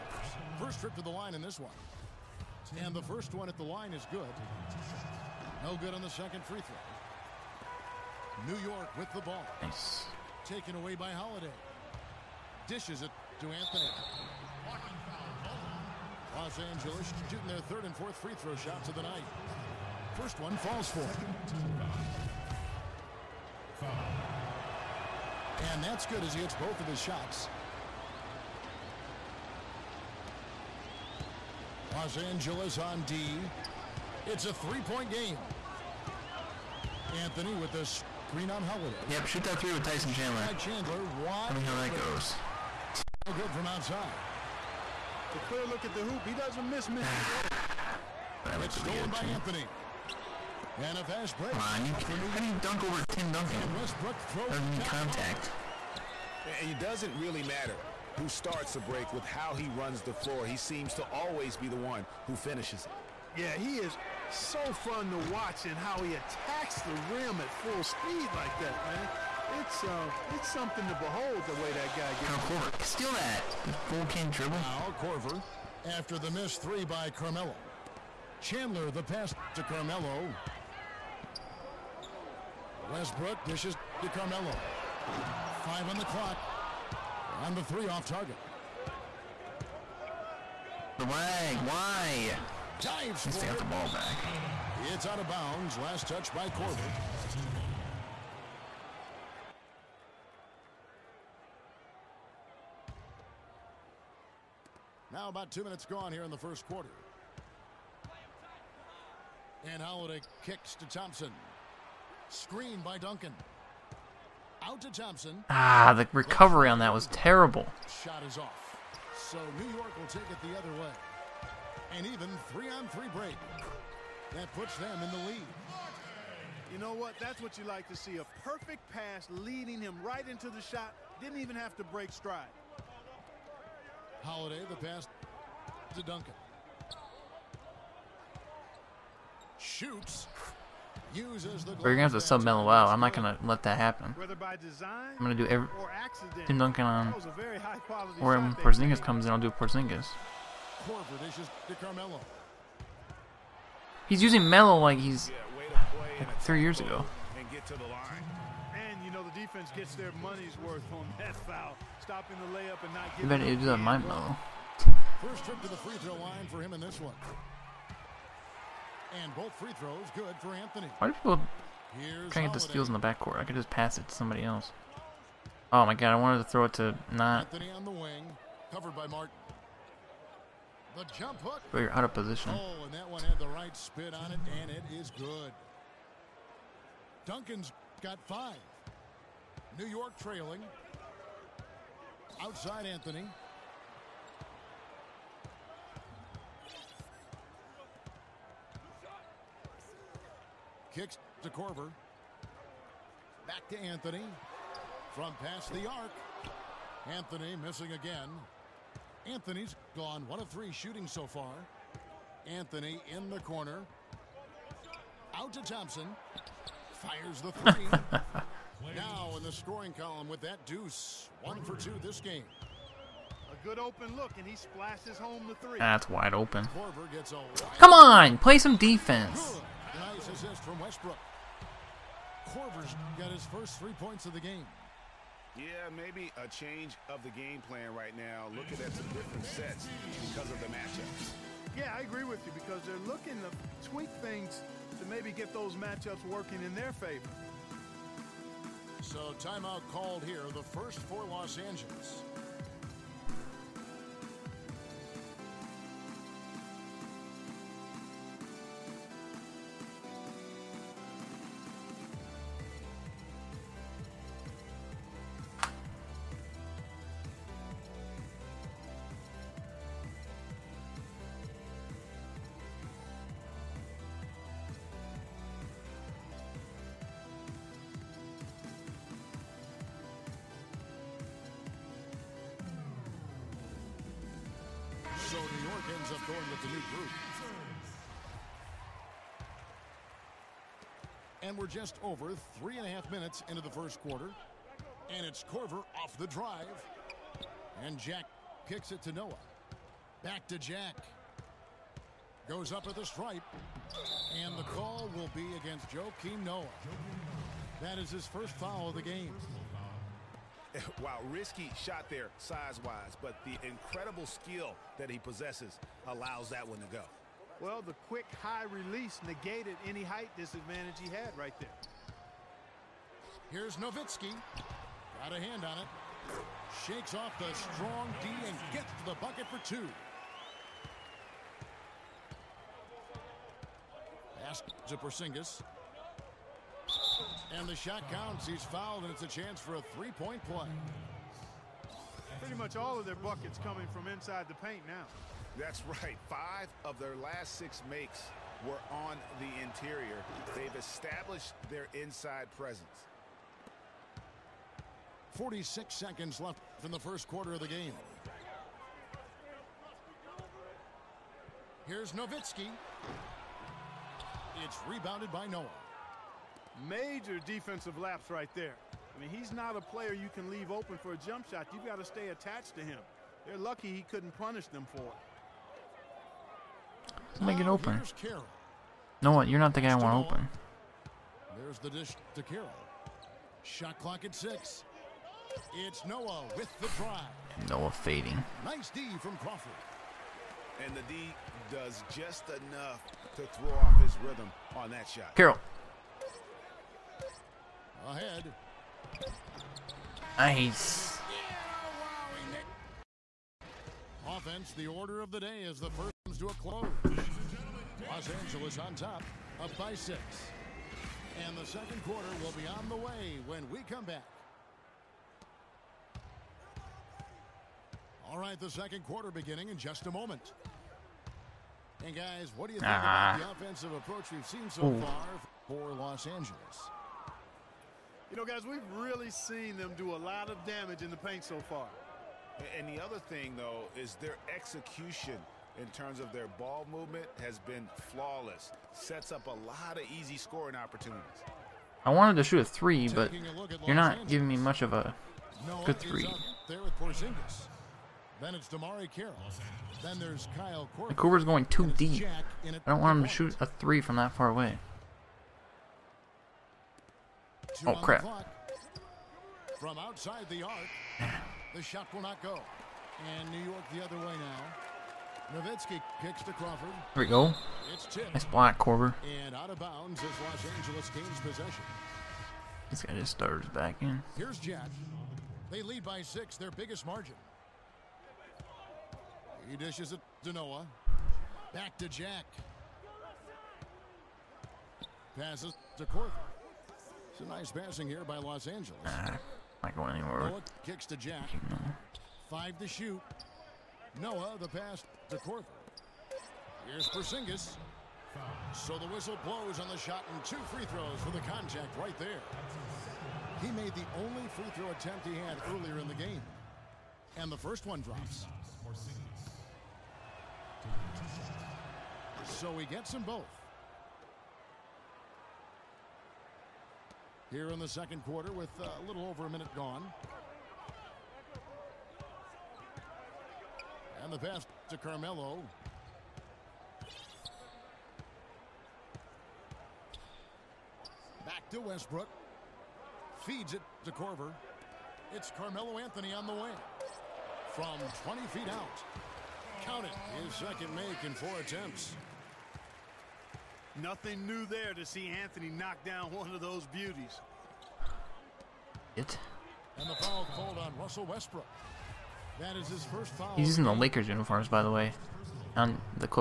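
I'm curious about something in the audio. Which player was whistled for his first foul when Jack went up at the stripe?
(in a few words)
Joakim Noah.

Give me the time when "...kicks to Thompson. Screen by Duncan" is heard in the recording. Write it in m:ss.
1:50.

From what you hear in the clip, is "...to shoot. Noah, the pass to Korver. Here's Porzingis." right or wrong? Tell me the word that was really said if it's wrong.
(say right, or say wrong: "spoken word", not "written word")
right.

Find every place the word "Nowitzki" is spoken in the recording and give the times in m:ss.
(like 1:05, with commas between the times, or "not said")
5:23, 6:02, 7:45.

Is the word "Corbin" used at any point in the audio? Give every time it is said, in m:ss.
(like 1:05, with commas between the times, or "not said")
1:36.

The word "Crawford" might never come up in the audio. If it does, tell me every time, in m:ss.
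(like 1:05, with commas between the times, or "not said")
6:29, 7:46.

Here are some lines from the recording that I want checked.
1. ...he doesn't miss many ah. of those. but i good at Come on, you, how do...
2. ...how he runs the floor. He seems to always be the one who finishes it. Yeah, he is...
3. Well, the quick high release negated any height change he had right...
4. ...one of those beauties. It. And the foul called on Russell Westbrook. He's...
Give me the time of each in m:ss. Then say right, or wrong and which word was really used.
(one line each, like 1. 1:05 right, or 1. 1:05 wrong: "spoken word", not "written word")
1. 0:46 right
2. 0:59 right
3. 5:17 wrong: "disadvantage", not "change"
4. 9:06 right.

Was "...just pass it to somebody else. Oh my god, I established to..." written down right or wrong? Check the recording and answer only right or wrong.
wrong.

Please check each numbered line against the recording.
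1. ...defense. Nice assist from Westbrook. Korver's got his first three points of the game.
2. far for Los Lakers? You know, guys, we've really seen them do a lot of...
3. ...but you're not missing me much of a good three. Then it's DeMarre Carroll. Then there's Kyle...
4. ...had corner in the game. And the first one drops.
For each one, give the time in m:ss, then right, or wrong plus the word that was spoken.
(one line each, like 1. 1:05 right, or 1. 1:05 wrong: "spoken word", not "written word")
1. 3:48 right
2. 7:04 wrong: "Angeles", not "Lakers"
3. 7:23 wrong: "giving", not "missing"
4. 8:25 wrong: "earlier", not "corner".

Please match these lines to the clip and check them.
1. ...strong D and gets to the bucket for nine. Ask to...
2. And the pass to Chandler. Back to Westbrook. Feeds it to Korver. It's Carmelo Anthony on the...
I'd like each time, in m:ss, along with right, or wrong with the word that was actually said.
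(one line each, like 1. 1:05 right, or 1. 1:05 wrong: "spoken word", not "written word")
1. 5:27 wrong: "two", not "nine"
2. 8:44 wrong: "Carmelo", not "Chandler".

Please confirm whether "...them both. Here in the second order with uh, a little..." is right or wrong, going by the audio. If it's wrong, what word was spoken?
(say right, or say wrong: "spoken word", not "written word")
wrong: "quarter", not "order".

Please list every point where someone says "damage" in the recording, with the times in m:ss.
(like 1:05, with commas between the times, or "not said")
7:10.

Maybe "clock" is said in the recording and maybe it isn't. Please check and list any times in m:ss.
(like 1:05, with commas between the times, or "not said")
1:26, 6:23.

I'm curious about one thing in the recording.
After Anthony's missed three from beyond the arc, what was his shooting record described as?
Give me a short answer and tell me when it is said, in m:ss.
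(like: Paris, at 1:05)
1 of 3, at 3:30.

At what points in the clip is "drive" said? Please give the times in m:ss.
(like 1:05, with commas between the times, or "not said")
4:56, 6:26.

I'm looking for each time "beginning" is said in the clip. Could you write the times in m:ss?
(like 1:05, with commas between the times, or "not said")
6:59.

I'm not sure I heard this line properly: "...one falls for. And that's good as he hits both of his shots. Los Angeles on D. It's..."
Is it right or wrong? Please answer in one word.
right.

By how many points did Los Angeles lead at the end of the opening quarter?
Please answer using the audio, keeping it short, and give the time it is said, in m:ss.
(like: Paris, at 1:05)
6, at 6:49.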